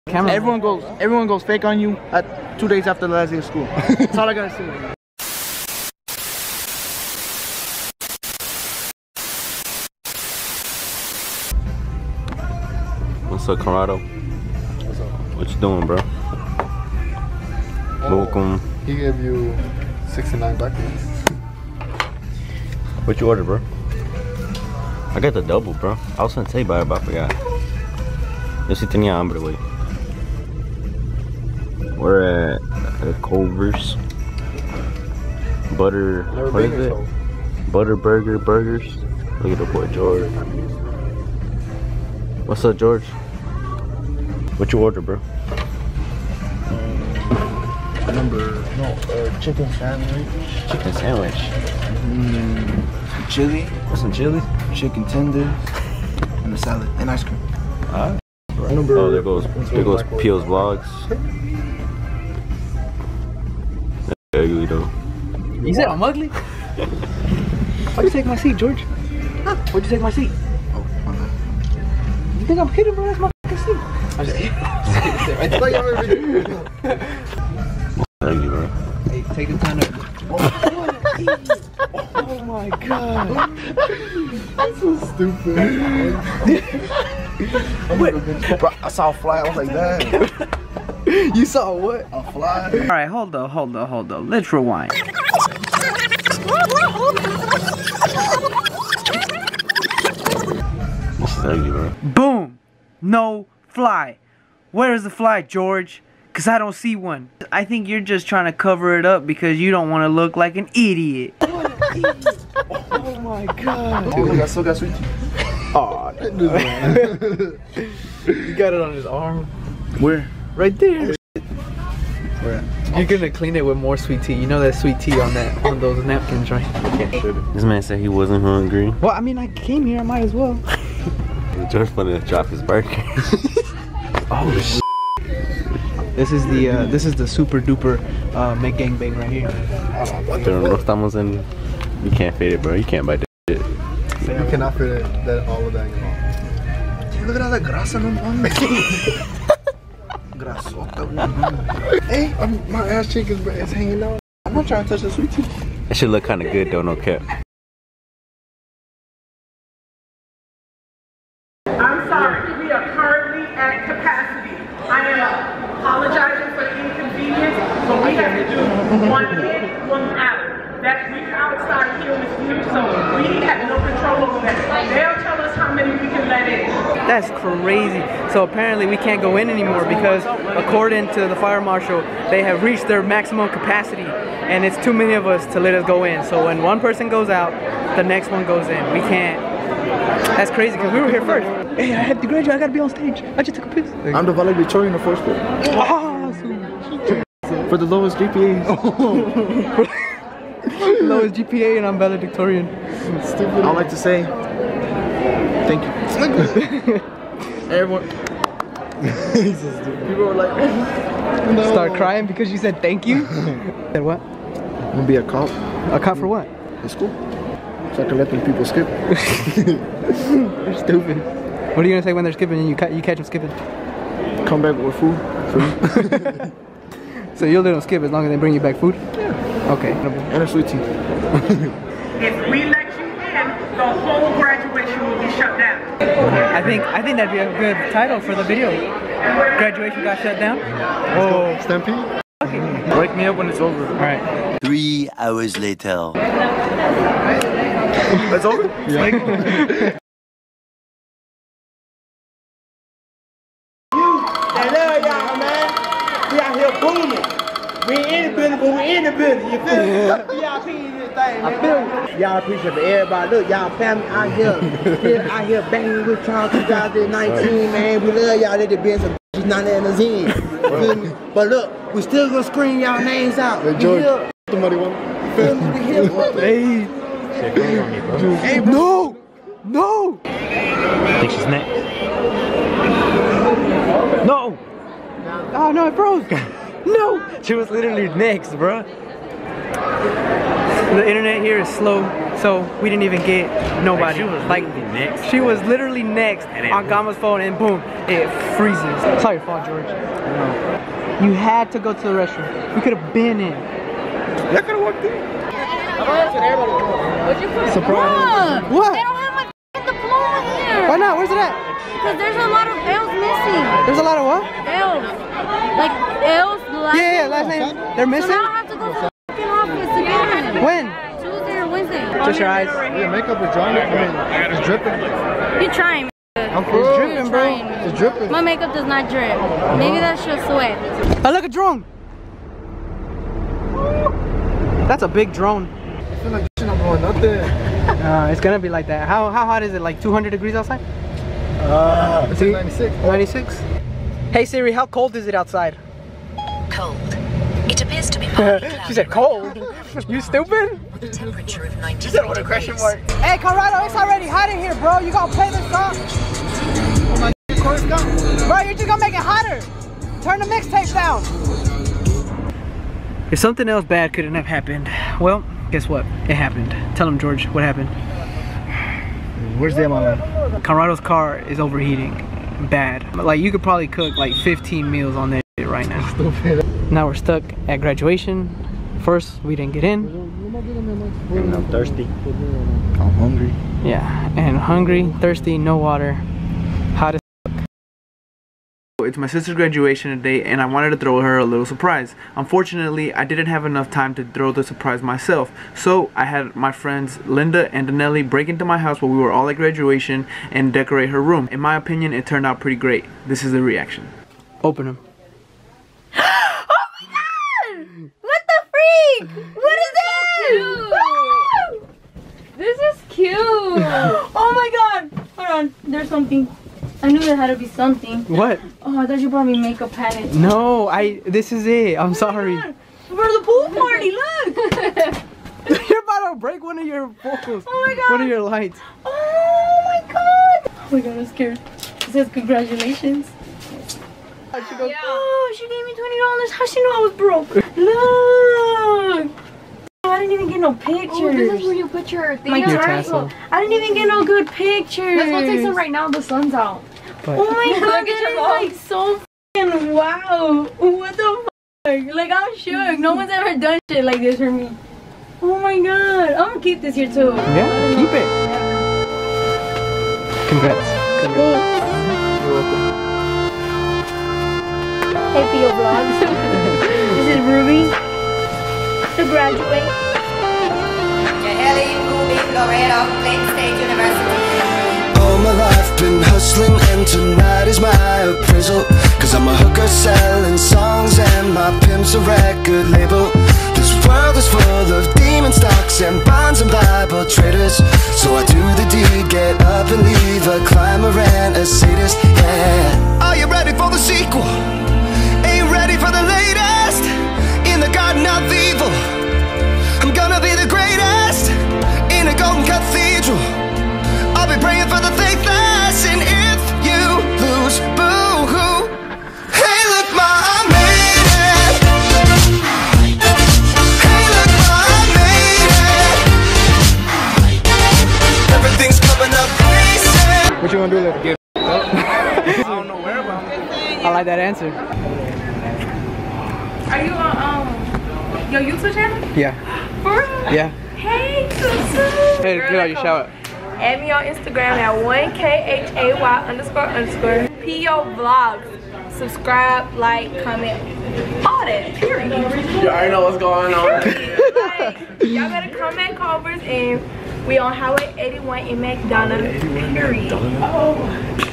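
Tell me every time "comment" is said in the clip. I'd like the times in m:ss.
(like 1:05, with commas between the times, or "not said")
9:00.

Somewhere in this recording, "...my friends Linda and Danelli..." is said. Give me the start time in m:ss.
6:36.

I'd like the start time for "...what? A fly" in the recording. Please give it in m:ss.
1:31.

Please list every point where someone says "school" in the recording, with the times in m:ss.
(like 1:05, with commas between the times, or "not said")
0:03.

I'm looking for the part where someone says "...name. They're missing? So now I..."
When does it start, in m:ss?
5:17.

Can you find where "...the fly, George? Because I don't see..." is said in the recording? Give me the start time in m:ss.
1:45.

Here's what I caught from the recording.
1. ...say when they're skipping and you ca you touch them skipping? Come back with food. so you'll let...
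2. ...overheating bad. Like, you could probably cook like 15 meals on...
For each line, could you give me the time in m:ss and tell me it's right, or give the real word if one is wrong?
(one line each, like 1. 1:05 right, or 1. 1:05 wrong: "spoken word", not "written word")
1. 3:42 wrong: "catch", not "touch"
2. 6:11 right.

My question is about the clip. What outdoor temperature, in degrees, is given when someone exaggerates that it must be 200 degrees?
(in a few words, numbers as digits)
96.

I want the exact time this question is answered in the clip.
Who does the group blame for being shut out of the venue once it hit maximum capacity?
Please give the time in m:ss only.
3:01.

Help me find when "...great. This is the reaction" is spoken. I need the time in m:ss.
6:42.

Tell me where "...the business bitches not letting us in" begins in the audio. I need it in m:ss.
4:28.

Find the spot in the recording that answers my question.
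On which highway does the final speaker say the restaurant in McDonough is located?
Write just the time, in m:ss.
9:07.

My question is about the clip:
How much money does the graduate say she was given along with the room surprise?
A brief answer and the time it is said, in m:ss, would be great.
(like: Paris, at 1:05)
$20, at 7:15.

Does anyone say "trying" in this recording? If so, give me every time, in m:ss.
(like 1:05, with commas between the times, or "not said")
1:48, 2:34, 5:25.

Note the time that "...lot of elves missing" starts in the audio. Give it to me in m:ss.
5:12.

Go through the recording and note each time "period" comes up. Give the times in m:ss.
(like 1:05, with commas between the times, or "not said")
9:01, 9:09.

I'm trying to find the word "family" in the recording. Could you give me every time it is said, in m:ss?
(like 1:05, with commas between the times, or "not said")
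4:23.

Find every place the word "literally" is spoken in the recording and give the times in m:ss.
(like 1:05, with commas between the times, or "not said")
4:47, 4:55.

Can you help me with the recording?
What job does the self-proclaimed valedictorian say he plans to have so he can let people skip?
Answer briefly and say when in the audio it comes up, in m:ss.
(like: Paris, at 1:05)
A cop, at 3:34.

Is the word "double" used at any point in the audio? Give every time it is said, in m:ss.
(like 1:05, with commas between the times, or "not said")
0:25.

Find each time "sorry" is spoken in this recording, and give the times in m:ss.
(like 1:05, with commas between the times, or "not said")
2:42, 4:59, 7:02.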